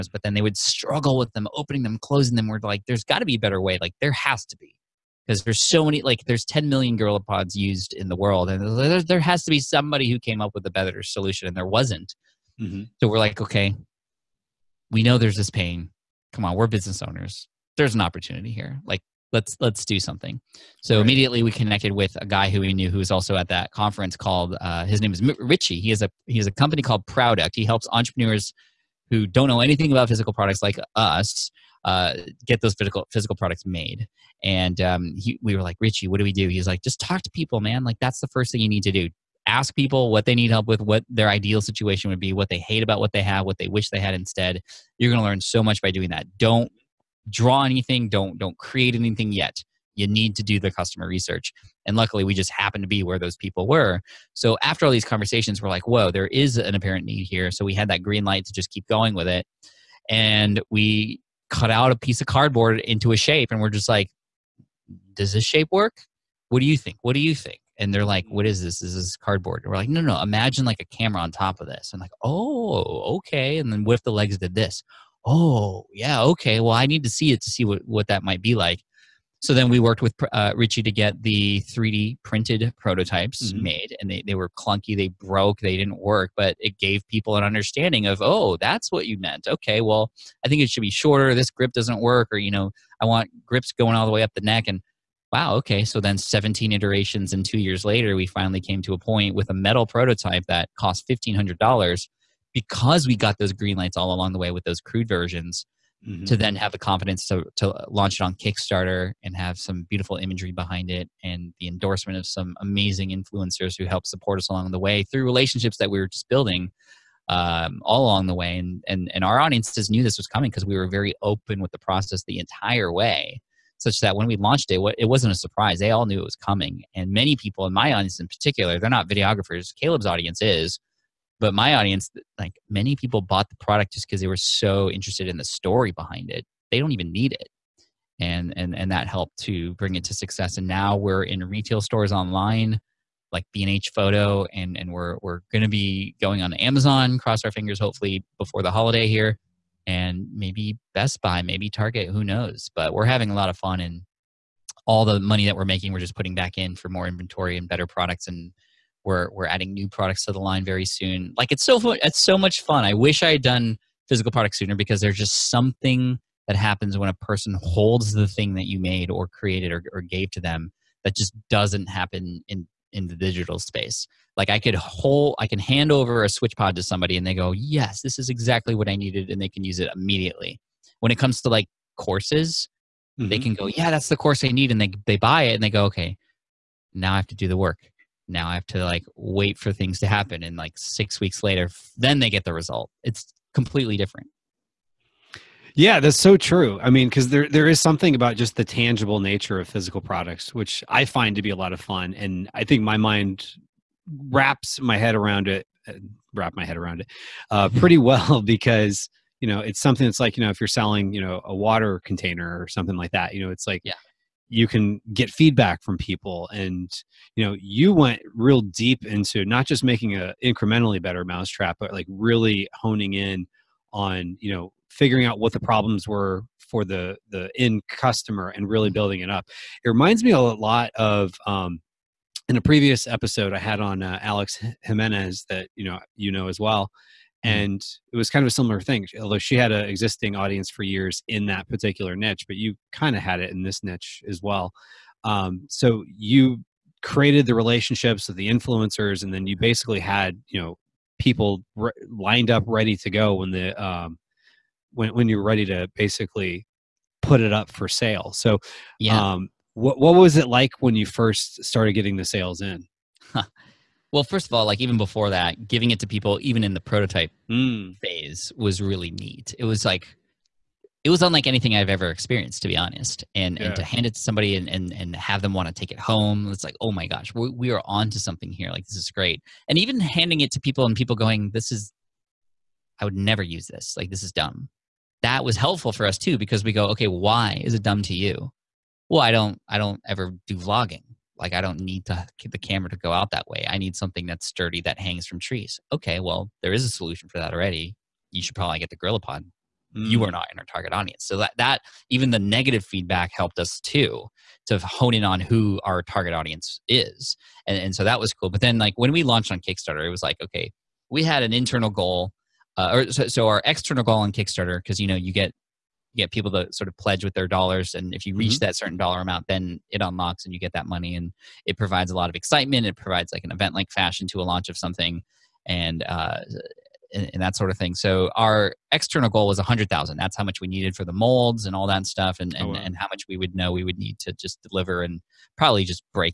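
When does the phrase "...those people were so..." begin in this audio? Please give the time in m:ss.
0:53.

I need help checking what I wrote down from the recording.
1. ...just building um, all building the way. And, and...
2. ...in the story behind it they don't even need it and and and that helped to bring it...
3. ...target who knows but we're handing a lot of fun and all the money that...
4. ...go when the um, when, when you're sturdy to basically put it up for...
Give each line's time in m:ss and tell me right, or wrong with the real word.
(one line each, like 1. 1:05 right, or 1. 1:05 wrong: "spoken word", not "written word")
1. 1:56 wrong: "along", not "building"
2. 2:15 right
3. 2:31 wrong: "having", not "handing"
4. 4:13 wrong: "ready", not "sturdy".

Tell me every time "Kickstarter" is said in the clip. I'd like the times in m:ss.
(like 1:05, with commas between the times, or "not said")
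1:48, 5:09, 5:14.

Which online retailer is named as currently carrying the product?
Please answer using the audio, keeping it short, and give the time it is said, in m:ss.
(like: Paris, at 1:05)
B&H Photo, at 2:23.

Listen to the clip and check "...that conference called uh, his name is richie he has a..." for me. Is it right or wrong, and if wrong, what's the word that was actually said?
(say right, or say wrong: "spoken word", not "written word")
right.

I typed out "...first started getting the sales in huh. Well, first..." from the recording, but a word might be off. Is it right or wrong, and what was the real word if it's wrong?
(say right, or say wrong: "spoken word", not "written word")
right.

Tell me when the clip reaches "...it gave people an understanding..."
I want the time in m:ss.
1:26.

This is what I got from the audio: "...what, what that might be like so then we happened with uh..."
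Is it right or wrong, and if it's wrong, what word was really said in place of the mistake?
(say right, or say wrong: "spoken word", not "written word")
wrong: "worked", not "happened".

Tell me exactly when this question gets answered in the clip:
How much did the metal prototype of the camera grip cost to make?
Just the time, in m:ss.
1:41.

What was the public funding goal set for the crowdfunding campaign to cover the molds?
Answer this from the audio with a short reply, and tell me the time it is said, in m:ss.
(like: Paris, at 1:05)
100000, at 5:29.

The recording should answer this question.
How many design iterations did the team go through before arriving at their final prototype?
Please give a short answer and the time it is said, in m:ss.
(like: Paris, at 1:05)
17, at 1:36.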